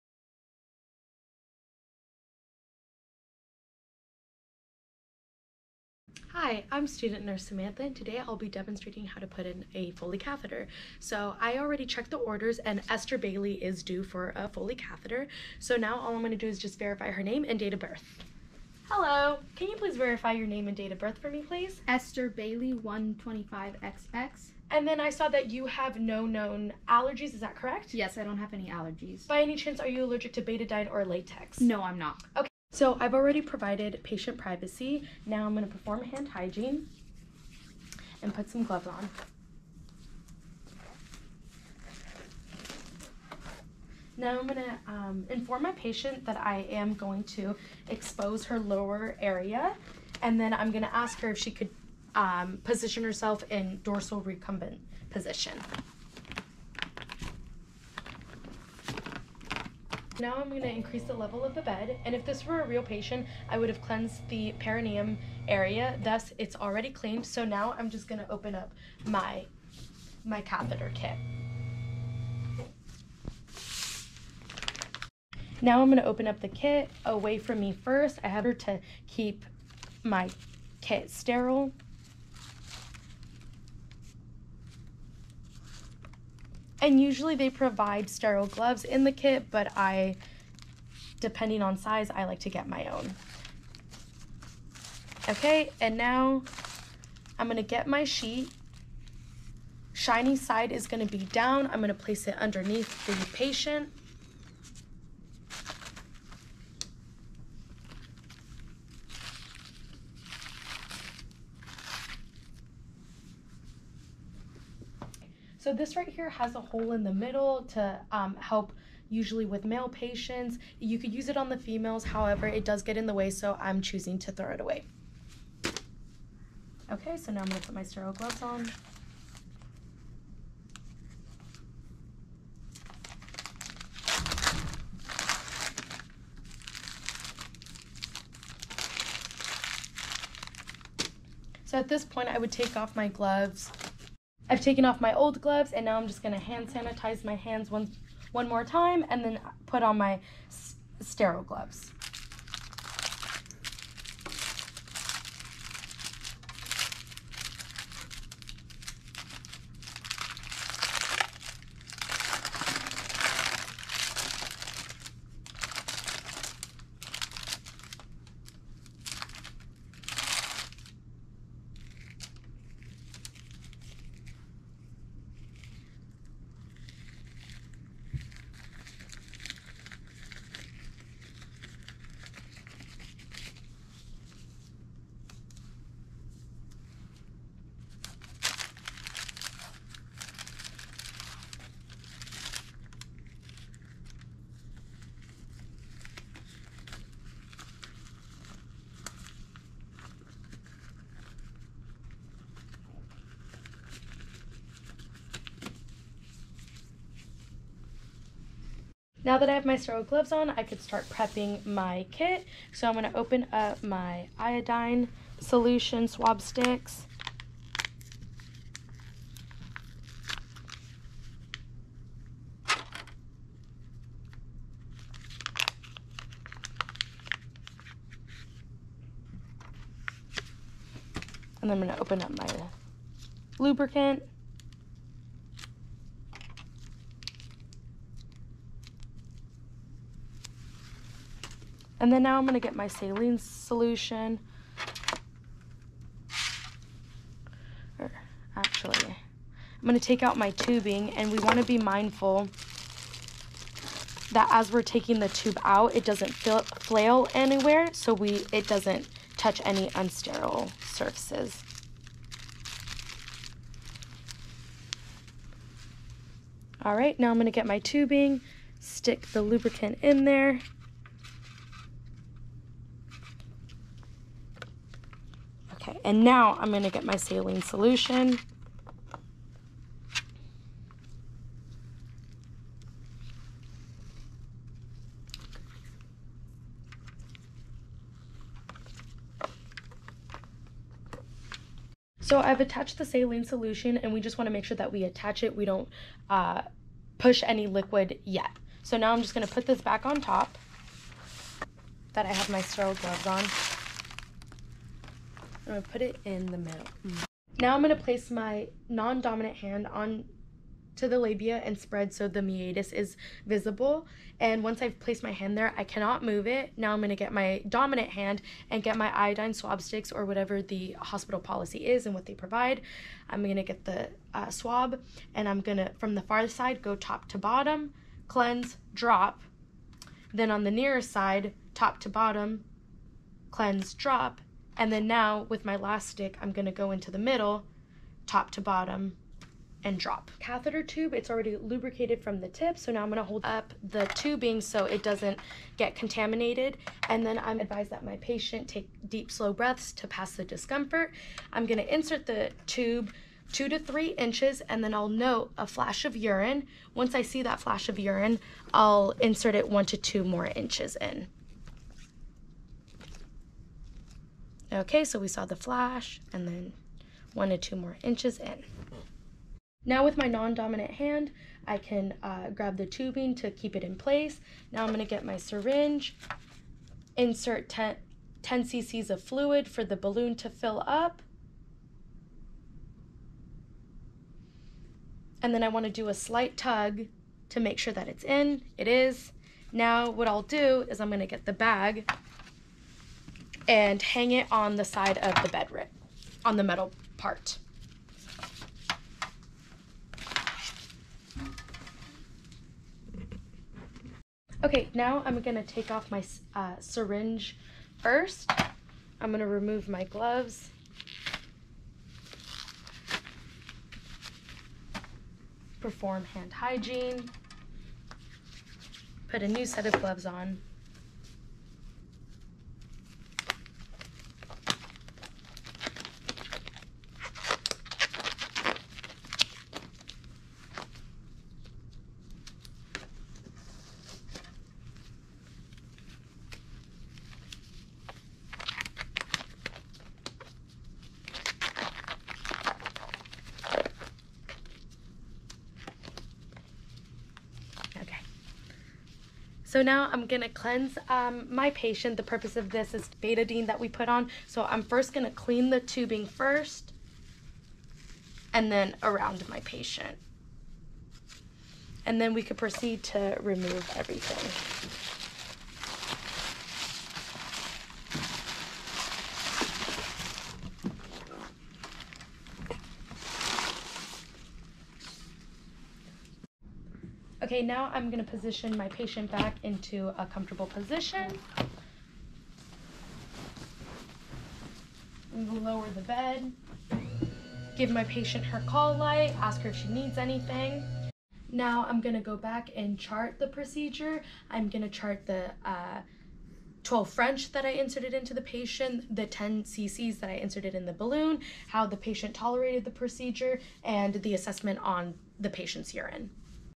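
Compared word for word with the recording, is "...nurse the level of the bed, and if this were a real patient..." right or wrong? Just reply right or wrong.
wrong.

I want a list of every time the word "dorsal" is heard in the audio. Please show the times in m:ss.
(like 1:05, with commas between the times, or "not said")
0:53.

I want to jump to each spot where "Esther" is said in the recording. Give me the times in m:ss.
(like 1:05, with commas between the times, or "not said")
0:12, 0:21.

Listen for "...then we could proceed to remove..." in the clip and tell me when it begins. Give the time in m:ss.
7:42.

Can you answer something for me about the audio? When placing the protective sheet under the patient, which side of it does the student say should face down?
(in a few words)
Shiny side.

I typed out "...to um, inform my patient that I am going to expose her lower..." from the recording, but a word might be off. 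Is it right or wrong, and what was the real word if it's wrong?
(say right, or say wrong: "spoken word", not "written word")
right.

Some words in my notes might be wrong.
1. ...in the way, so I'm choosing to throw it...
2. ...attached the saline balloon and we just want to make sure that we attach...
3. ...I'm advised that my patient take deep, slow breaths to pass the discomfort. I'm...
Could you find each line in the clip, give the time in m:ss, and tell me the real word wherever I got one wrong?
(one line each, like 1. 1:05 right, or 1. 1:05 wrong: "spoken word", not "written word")
1. 2:02 right
2. 4:52 wrong: "solution", not "balloon"
3. 5:47 right.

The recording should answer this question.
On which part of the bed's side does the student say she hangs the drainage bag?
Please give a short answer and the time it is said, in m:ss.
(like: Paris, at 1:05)
The metal part, at 6:36.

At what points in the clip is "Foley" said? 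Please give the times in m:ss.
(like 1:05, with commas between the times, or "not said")
0:09, 0:14.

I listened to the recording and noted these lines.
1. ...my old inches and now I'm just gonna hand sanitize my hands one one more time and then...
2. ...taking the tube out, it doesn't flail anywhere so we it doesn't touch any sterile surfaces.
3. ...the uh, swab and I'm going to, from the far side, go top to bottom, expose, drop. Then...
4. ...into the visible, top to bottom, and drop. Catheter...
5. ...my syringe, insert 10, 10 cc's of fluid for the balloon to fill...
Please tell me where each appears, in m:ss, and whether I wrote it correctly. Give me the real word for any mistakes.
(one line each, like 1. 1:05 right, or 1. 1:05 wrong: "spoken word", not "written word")
1. 2:24 wrong: "gloves", not "inches"
2. 4:14 wrong: "unsterile", not "sterile"
3. 5:23 wrong: "cleanse", not "expose"
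4. 5:36 wrong: "middle", not "visible"
5. 6:15 right.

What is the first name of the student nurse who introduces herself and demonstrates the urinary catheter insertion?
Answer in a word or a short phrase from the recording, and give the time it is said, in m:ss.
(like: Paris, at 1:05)
Samantha, at 0:07.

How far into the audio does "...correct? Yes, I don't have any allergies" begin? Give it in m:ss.
0:27.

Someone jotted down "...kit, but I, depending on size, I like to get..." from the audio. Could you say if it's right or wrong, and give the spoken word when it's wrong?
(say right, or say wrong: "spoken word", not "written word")
right.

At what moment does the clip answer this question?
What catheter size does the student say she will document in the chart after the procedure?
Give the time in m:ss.
8:16.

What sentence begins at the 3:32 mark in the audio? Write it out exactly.
So I'm going to open up my iodine solution swab sticks.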